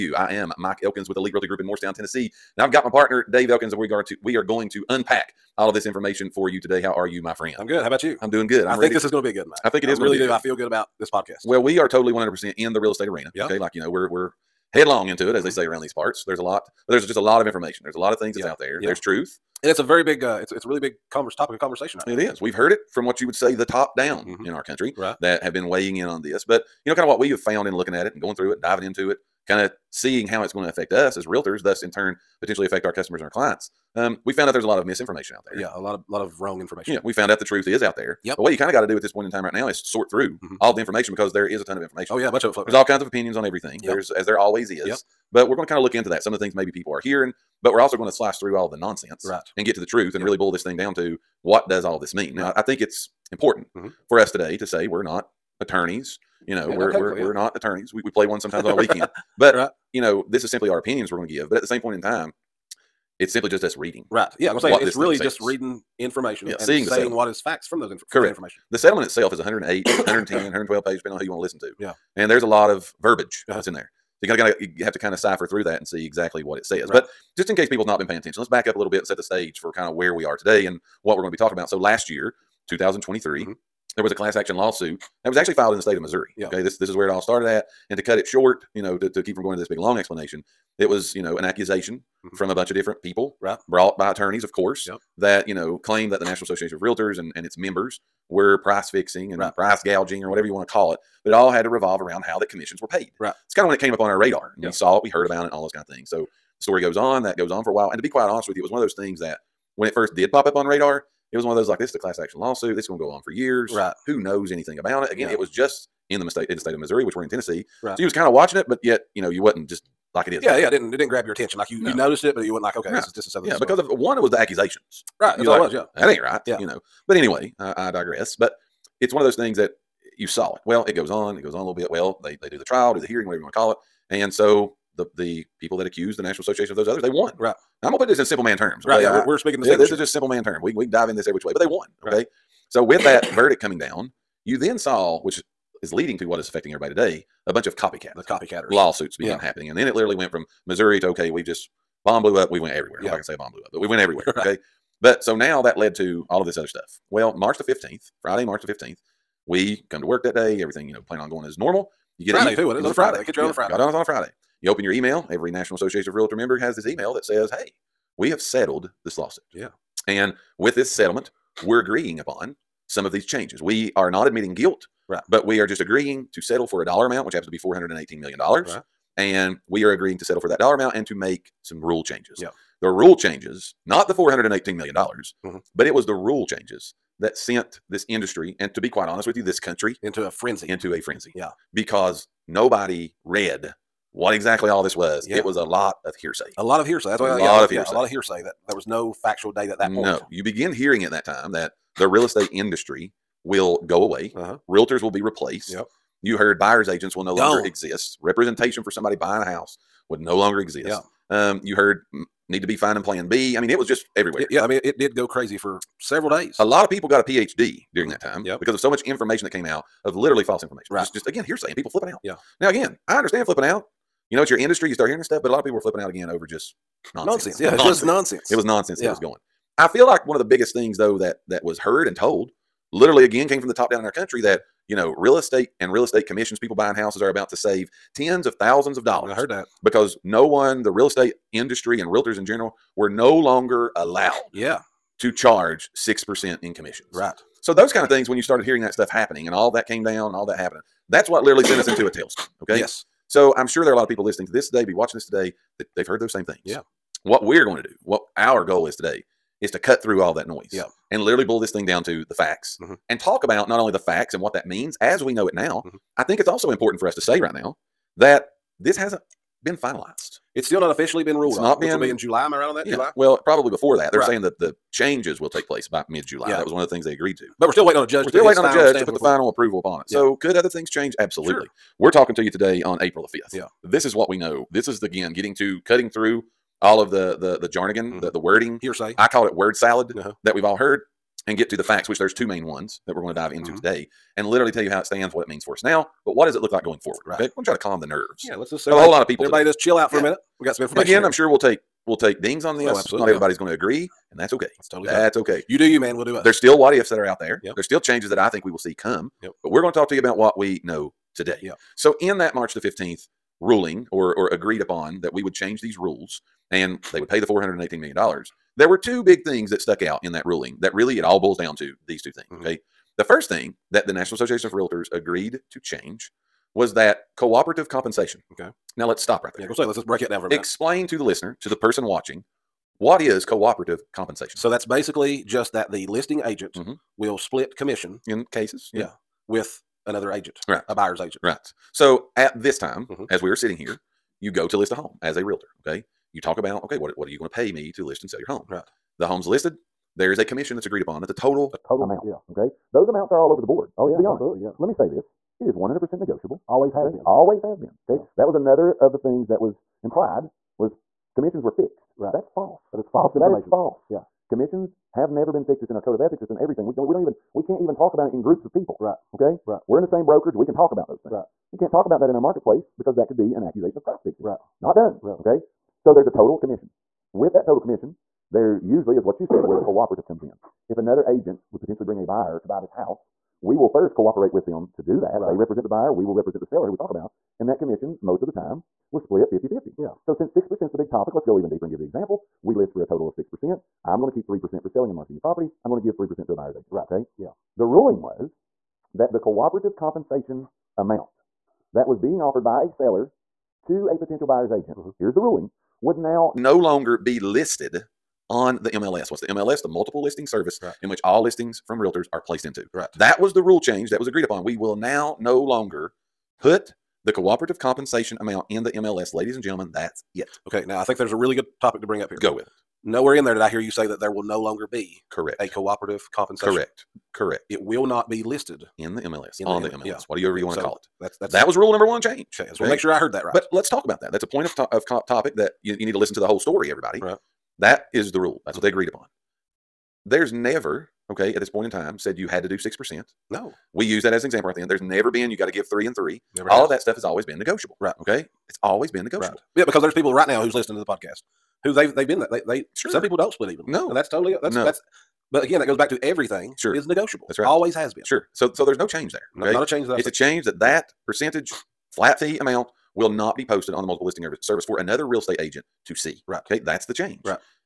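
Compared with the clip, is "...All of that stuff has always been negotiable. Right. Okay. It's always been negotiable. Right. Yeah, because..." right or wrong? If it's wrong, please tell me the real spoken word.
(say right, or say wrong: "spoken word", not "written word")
right.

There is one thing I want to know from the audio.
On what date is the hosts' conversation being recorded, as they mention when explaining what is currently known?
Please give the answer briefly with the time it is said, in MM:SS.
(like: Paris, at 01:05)
April 5, at 04:43.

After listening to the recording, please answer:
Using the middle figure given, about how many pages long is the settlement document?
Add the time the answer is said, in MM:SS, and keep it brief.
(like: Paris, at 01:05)
110, at 01:09.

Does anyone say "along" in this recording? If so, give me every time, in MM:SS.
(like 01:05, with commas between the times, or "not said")
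not said.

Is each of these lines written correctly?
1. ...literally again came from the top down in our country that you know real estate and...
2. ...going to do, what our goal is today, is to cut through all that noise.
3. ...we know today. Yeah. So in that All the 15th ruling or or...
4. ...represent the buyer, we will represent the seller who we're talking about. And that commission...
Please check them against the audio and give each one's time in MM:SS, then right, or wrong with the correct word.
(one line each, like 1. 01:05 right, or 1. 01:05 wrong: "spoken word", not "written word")
1. 03:52 right
2. 04:17 right
3. 05:10 wrong: "March", not "All"
4. 06:25 right.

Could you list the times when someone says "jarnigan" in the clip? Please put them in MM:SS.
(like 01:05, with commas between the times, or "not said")
04:47.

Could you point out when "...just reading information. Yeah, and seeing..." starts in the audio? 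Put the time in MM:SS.
01:05.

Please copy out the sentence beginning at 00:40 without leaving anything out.
all the information because there is a ton of information.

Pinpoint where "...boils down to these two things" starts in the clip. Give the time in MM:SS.
05:21.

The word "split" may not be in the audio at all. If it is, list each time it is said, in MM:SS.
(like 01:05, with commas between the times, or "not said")
05:37, 06:29, 07:33.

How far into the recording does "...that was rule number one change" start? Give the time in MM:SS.
07:11.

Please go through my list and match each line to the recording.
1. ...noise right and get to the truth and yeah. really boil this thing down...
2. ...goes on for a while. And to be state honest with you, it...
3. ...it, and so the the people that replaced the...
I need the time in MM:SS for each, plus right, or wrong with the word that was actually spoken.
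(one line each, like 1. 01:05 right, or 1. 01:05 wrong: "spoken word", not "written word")
1. 00:48 wrong: "nonsense", not "noise"
2. 01:47 wrong: "quite", not "state"
3. 02:13 wrong: "accused", not "replaced".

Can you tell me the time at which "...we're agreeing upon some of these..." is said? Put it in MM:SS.
02:51.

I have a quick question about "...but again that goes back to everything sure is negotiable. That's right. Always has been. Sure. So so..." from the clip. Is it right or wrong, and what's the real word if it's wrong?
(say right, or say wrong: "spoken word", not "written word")
right.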